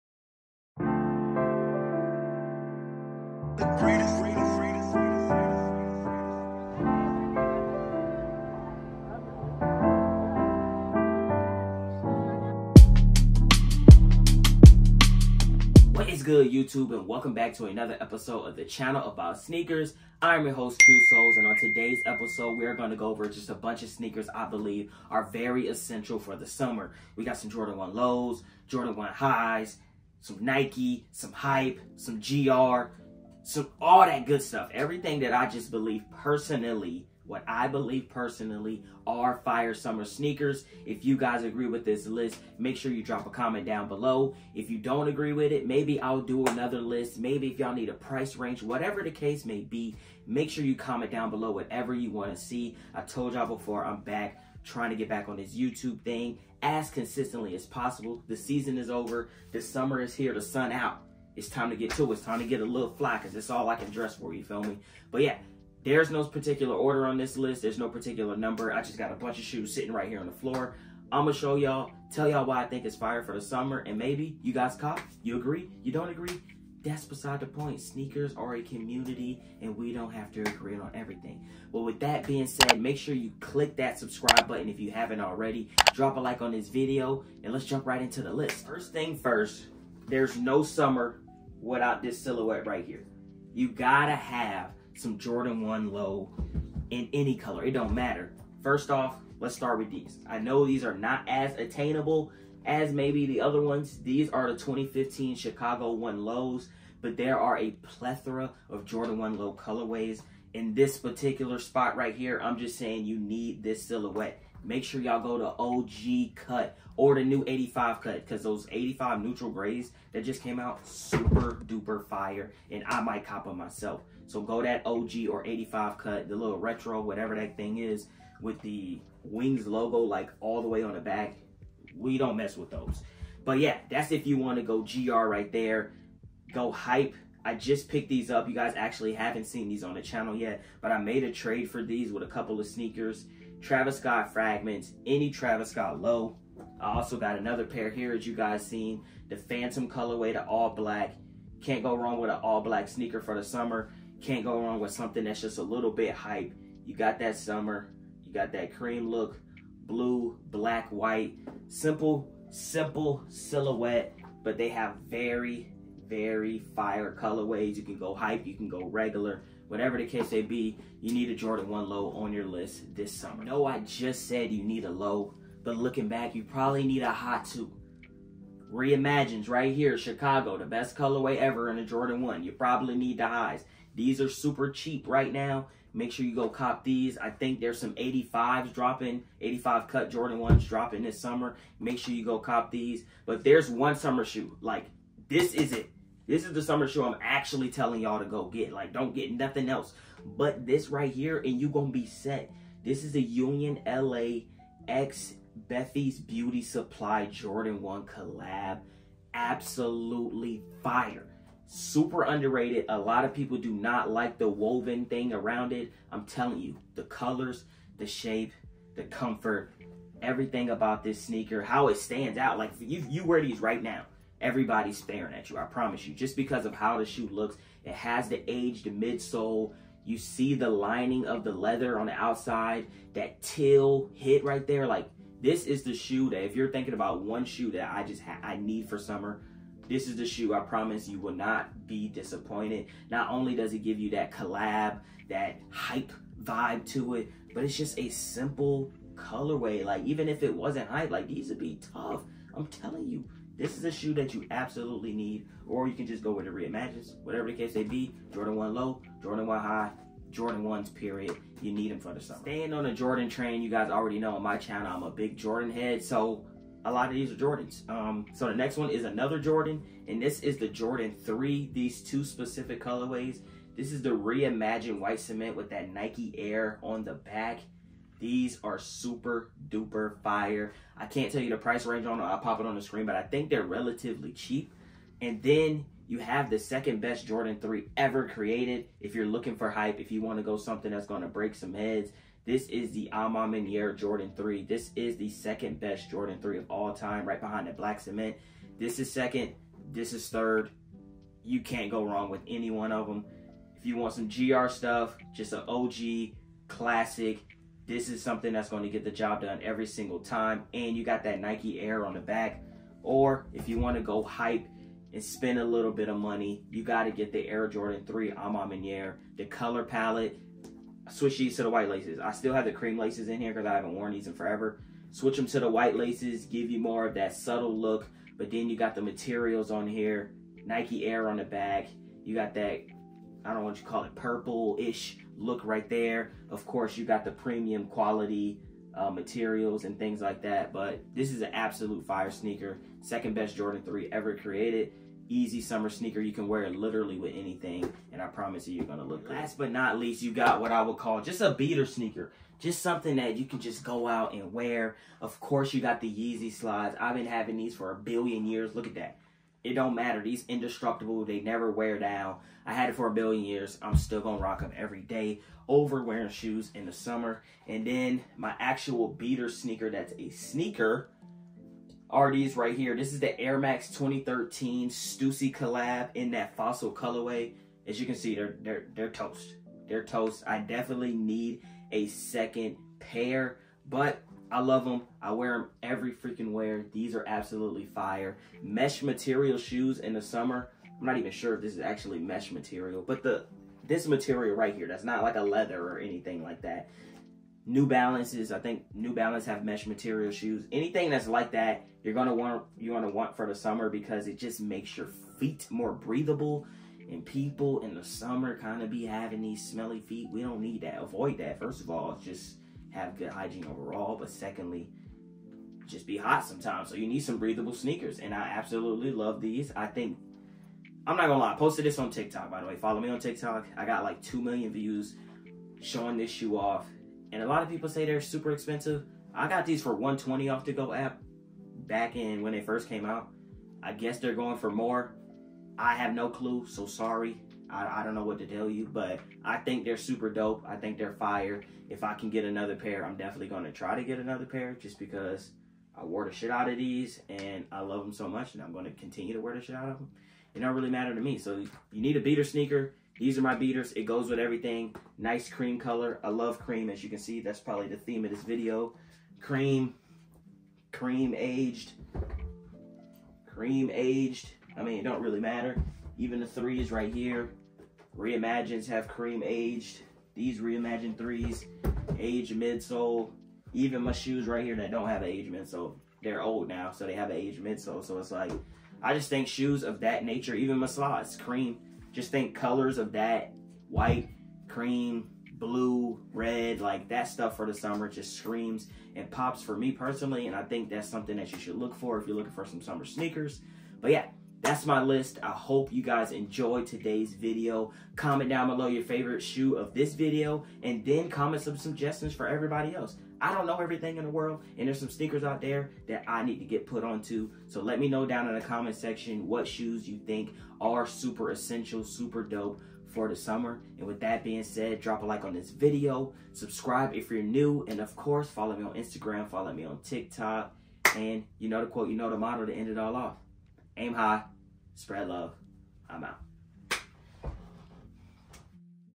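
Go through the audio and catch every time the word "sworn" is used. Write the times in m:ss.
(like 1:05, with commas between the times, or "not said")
not said.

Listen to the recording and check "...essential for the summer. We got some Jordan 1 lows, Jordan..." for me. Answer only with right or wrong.
right.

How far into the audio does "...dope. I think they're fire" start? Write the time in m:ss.
7:20.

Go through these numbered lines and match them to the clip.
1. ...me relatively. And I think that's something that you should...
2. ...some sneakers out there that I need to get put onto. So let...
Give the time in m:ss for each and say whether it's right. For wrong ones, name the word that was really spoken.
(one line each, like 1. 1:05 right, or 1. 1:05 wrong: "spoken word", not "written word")
1. 8:09 wrong: "personally", not "relatively"
2. 8:24 right.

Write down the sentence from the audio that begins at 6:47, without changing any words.
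And people in the summer kind of be having these smelly feet.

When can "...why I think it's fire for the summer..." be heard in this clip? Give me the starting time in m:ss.
1:12.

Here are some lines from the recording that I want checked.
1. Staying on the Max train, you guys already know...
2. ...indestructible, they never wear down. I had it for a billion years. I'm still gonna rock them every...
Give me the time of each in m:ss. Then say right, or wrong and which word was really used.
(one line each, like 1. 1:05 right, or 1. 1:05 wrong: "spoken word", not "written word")
1. 4:22 wrong: "Jordan", not "Max"
2. 6:00 right.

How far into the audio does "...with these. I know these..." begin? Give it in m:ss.
1:39.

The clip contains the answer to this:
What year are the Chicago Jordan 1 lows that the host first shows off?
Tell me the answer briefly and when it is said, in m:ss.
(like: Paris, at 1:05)
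2015, at 1:44.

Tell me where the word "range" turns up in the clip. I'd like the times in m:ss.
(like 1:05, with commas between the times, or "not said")
0:48, 4:41.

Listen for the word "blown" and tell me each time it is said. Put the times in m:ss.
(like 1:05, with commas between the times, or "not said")
not said.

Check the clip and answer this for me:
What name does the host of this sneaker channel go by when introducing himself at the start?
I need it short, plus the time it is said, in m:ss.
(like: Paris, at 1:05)
Q Soles, at 0:20.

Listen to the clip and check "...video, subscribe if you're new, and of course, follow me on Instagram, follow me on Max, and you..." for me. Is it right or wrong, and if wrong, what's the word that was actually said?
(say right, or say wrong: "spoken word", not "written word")
wrong: "TikTok", not "Max".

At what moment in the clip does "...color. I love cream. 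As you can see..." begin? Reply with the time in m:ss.
7:35.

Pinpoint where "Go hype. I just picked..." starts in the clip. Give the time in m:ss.
2:16.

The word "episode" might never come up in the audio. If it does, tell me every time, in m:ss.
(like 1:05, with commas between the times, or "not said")
0:17, 0:22.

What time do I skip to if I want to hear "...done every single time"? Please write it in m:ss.
5:09.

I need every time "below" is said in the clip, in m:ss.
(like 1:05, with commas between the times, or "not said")
0:43, 0:51, 8:18.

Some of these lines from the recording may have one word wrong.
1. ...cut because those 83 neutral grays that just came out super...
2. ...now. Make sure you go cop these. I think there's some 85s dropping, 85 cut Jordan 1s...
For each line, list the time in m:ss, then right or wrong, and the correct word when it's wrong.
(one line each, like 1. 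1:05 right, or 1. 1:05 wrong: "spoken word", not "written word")
1. 1:58 wrong: "85", not "83"
2. 3:05 right.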